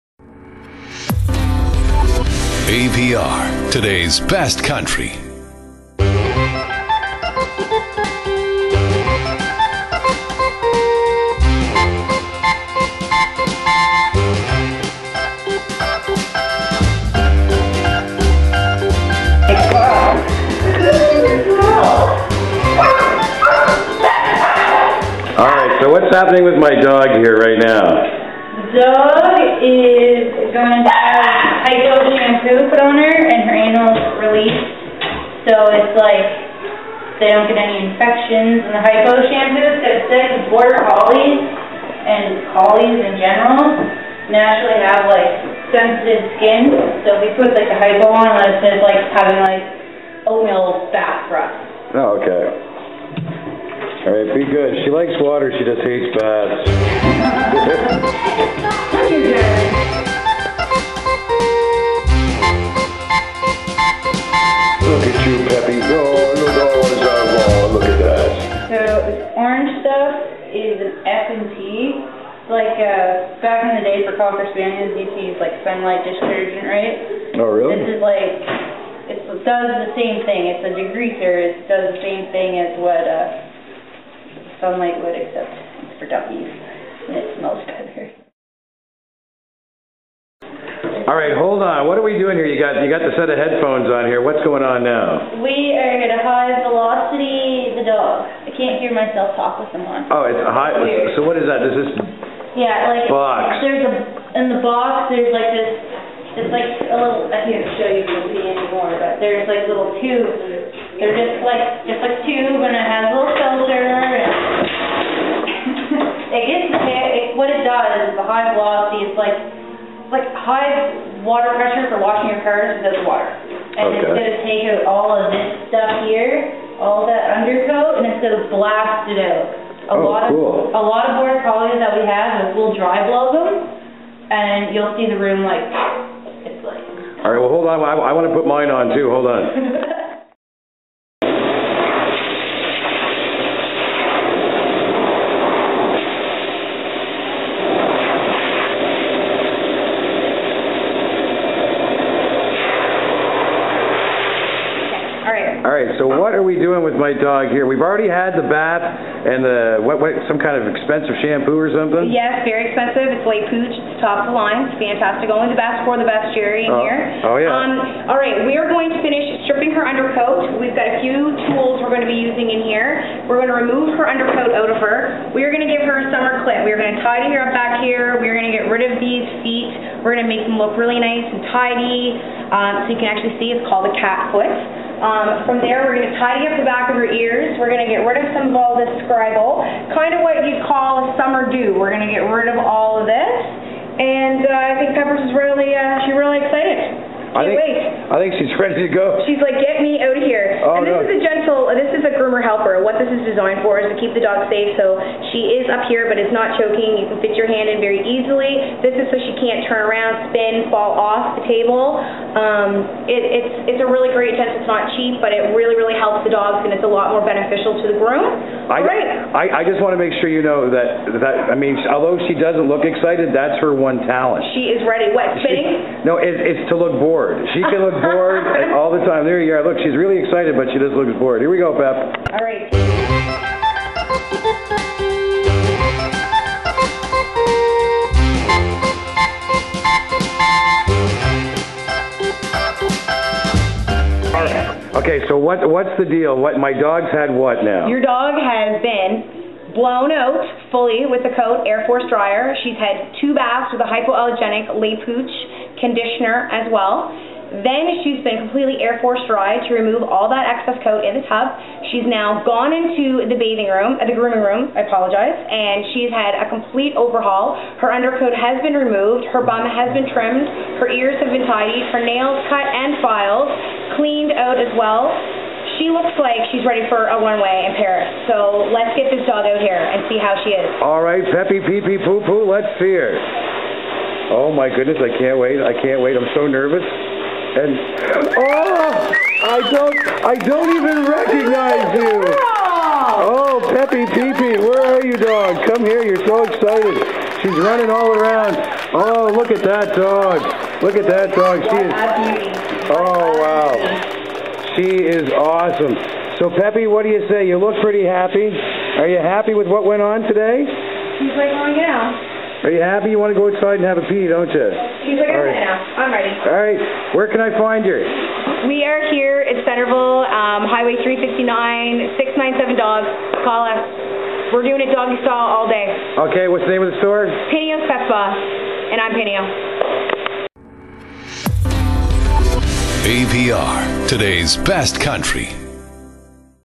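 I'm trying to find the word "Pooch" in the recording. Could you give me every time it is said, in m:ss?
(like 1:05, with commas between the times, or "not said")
2:43, 4:15.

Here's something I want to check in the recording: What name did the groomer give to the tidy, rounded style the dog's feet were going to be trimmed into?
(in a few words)
cat foot.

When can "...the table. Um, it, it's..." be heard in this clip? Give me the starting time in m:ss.
3:31.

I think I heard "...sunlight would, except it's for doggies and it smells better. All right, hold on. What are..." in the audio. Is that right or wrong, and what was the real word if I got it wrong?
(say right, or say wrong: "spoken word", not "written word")
right.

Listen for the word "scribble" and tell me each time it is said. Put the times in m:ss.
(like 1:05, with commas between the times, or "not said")
3:09.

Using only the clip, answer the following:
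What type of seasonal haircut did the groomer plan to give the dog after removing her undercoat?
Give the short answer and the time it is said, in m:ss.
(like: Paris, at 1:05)
summer clip, at 2:56.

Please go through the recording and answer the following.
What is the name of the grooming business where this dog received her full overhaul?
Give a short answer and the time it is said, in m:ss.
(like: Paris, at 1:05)
Pineo's Pet Spa, at 5:27.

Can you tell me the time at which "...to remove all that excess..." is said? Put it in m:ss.
4:19.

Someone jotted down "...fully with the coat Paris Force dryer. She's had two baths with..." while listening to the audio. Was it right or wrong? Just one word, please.
wrong.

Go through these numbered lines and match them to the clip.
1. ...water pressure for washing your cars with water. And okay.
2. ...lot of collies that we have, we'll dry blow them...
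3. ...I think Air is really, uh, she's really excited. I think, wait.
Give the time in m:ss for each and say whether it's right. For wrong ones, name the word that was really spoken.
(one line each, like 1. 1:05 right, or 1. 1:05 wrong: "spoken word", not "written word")
1. 2:01 right
2. 2:10 right
3. 3:14 wrong: "Peppers", not "Air".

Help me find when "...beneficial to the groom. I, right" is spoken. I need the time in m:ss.
3:37.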